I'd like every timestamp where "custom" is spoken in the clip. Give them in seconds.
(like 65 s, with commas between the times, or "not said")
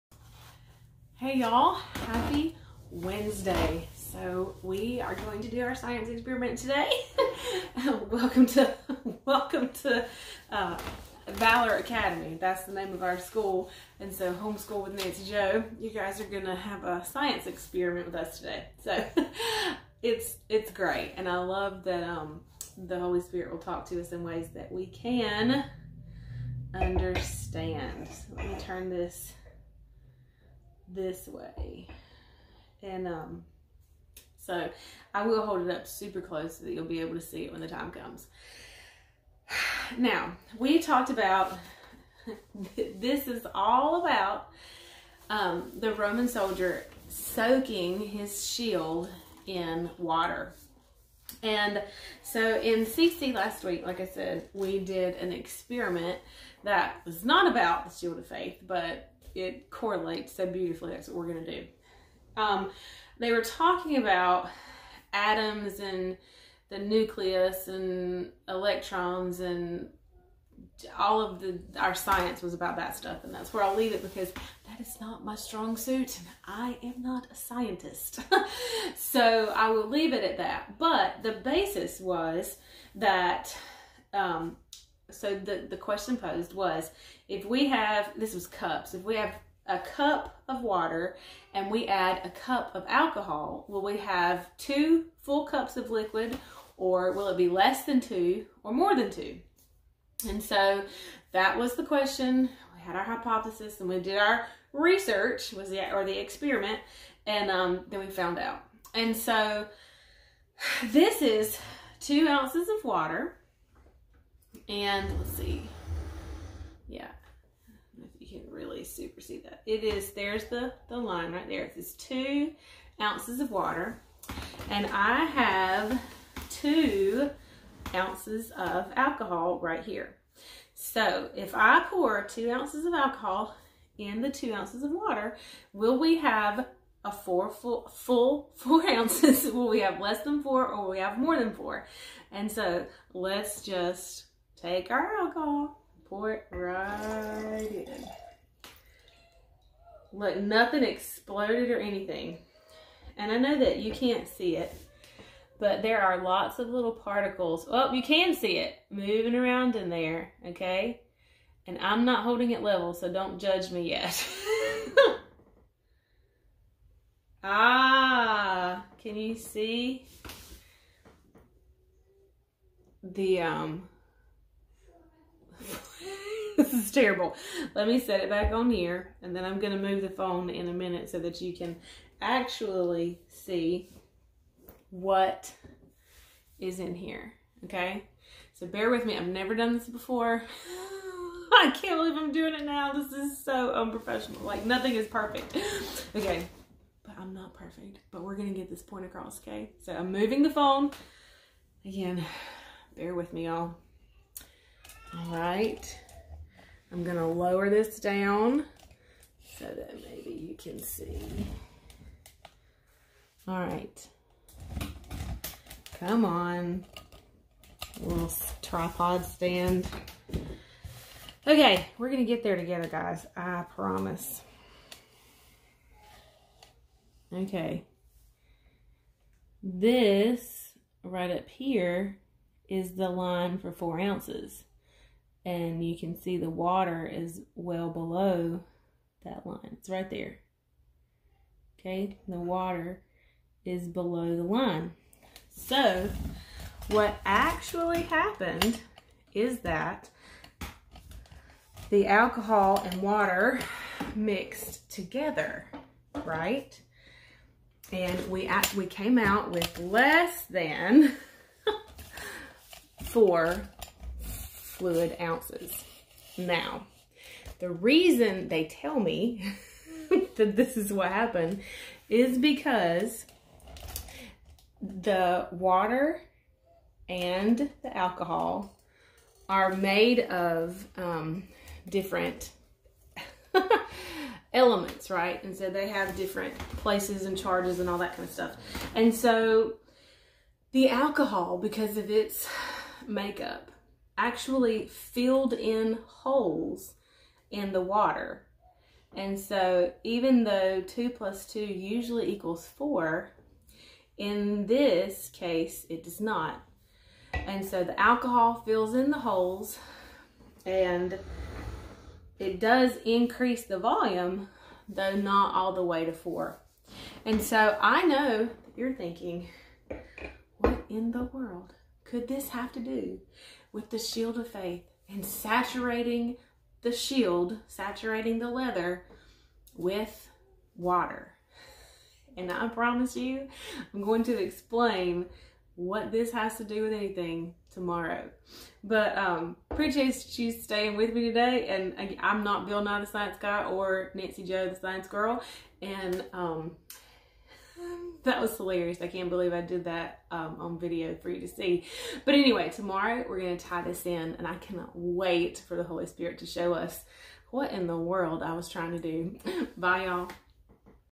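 not said.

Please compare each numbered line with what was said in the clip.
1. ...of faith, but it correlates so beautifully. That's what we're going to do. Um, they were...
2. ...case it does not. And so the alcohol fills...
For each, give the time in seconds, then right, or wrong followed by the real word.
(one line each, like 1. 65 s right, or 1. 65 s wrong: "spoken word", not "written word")
1. 58 s right
2. 305 s right.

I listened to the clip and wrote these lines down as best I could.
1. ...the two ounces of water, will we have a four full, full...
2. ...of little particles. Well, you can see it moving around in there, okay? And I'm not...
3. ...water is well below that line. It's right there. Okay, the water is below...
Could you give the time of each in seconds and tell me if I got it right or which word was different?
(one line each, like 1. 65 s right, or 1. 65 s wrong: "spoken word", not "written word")
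1. 134 s right
2. 156 s right
3. 236 s right.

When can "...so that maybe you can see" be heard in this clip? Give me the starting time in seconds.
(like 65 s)
209 s.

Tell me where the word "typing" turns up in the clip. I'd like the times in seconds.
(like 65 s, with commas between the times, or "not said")
not said.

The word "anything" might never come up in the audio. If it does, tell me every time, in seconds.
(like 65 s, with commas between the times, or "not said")
151 s, 336 s.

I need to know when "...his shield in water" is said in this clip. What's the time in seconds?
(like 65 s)
47 s.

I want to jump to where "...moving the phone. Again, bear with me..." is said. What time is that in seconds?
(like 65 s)
200 s.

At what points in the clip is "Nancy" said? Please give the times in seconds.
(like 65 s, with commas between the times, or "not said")
14 s, 344 s.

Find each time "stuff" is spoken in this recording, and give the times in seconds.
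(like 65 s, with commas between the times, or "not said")
72 s, 288 s.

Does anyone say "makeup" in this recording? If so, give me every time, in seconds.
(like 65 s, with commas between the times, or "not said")
293 s.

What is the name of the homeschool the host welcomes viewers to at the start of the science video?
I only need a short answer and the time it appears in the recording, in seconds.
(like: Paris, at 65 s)
Valor Academy, at 11 s.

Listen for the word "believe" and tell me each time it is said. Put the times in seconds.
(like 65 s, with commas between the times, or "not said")
191 s, 349 s.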